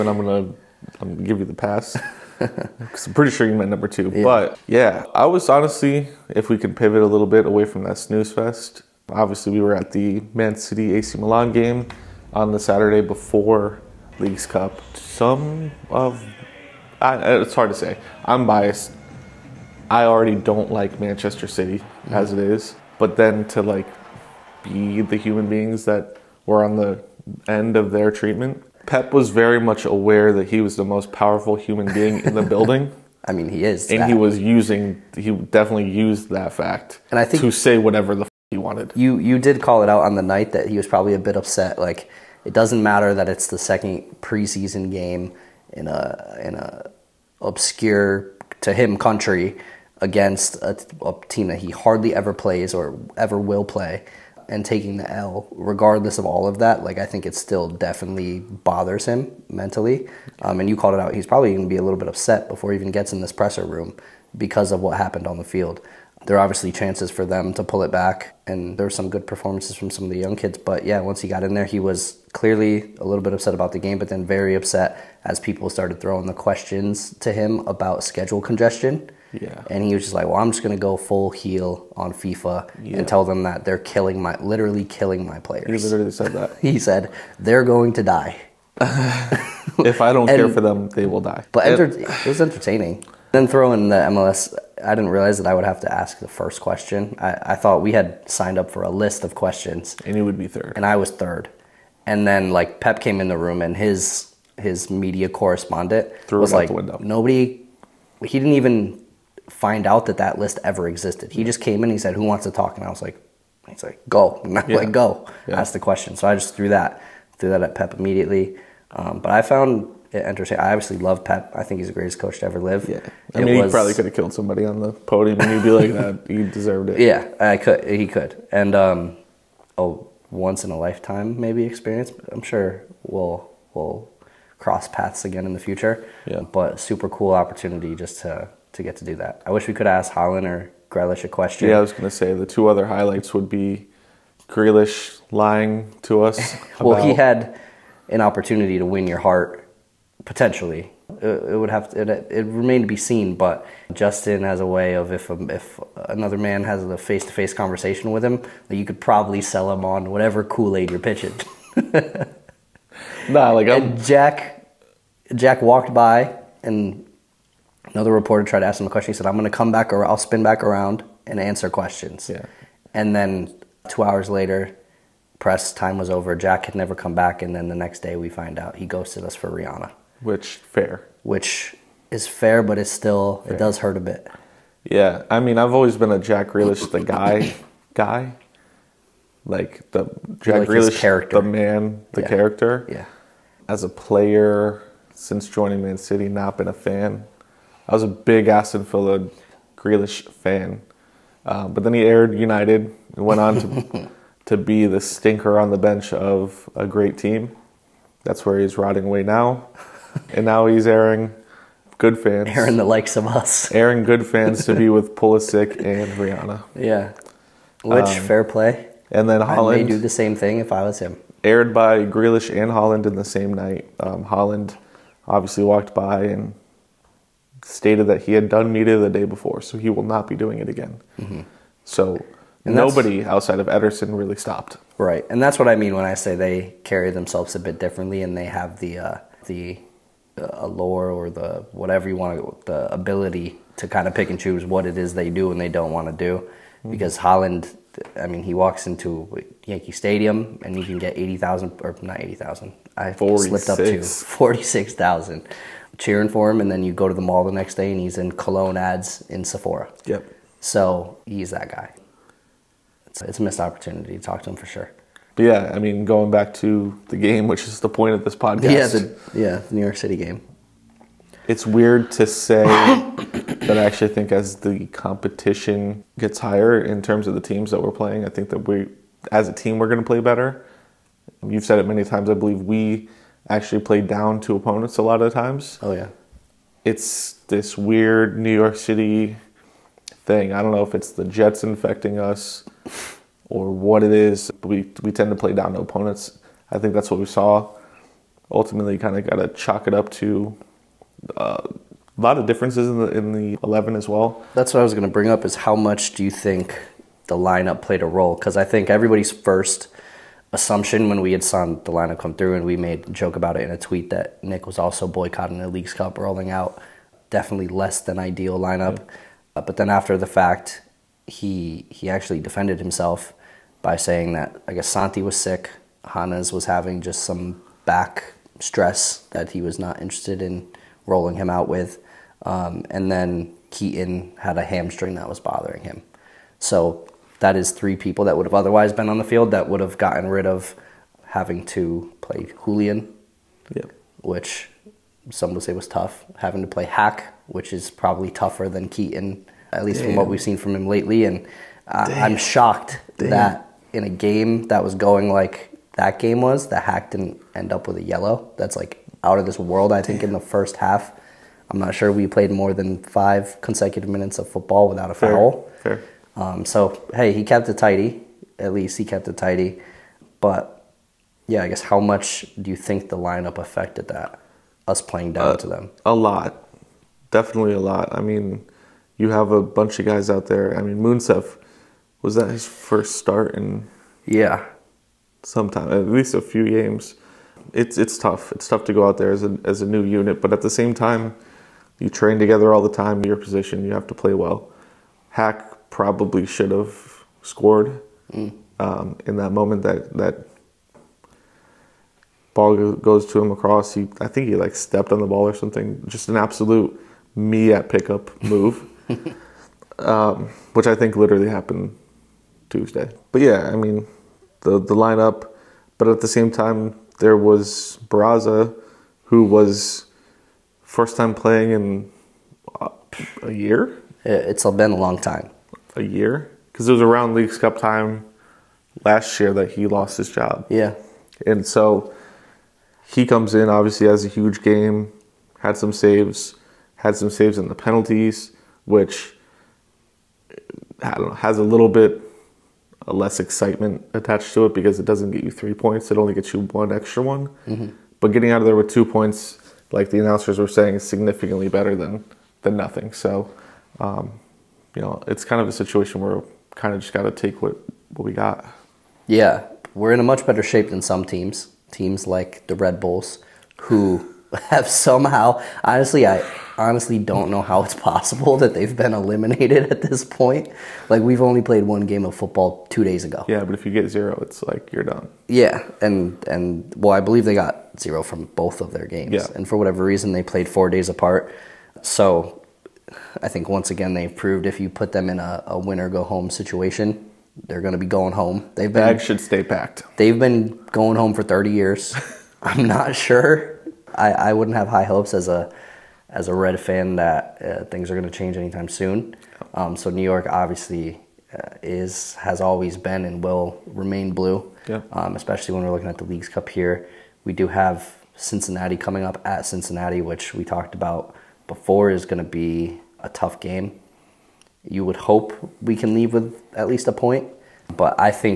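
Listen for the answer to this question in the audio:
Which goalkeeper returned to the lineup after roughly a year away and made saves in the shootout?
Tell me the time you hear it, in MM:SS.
06:58.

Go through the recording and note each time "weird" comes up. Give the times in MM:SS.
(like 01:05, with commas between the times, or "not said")
04:31, 04:47.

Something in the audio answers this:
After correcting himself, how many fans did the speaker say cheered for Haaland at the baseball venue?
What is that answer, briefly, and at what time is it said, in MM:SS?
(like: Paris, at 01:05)
46,000, at 04:14.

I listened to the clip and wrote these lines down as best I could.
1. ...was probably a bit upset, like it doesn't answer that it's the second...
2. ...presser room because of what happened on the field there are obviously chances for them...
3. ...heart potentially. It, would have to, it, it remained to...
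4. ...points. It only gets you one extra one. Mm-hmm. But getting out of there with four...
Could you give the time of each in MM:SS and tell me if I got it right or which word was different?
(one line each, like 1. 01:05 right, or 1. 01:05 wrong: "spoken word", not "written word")
1. 00:40 wrong: "matter", not "answer"
2. 01:03 right
3. 02:29 right
4. 07:25 wrong: "two", not "four".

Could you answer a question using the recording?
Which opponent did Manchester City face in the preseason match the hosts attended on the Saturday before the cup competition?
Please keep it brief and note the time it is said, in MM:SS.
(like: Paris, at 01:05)
AC Milan, at 00:10.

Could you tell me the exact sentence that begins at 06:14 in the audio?
Us playing down uh, to them.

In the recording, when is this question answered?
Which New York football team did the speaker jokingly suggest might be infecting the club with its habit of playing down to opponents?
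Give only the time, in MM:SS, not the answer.
04:51.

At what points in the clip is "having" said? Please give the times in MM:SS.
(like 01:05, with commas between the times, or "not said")
05:26, 05:41, 05:46.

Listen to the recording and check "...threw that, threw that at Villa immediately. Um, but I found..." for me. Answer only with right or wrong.
wrong.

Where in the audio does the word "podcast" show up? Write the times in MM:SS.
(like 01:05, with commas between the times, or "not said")
04:28.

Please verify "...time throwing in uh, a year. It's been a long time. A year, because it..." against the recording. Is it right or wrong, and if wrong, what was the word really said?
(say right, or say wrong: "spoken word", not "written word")
wrong: "playing", not "throwing".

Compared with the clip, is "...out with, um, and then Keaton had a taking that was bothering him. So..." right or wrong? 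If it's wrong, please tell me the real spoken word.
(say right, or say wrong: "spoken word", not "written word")
wrong: "hamstring", not "taking".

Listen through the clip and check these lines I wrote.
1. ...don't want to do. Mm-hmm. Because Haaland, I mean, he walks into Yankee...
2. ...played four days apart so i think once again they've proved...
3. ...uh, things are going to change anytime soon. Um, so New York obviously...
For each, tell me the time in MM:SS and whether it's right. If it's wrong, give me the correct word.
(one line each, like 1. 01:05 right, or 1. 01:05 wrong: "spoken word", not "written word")
1. 04:05 right
2. 08:00 right
3. 08:17 right.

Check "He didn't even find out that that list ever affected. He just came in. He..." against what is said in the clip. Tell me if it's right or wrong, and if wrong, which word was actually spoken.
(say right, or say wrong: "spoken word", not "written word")
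wrong: "existed", not "affected".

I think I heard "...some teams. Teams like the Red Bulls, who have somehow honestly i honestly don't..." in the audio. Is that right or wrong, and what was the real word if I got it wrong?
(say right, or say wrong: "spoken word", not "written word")
right.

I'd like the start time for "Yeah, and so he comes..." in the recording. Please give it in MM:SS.
07:10.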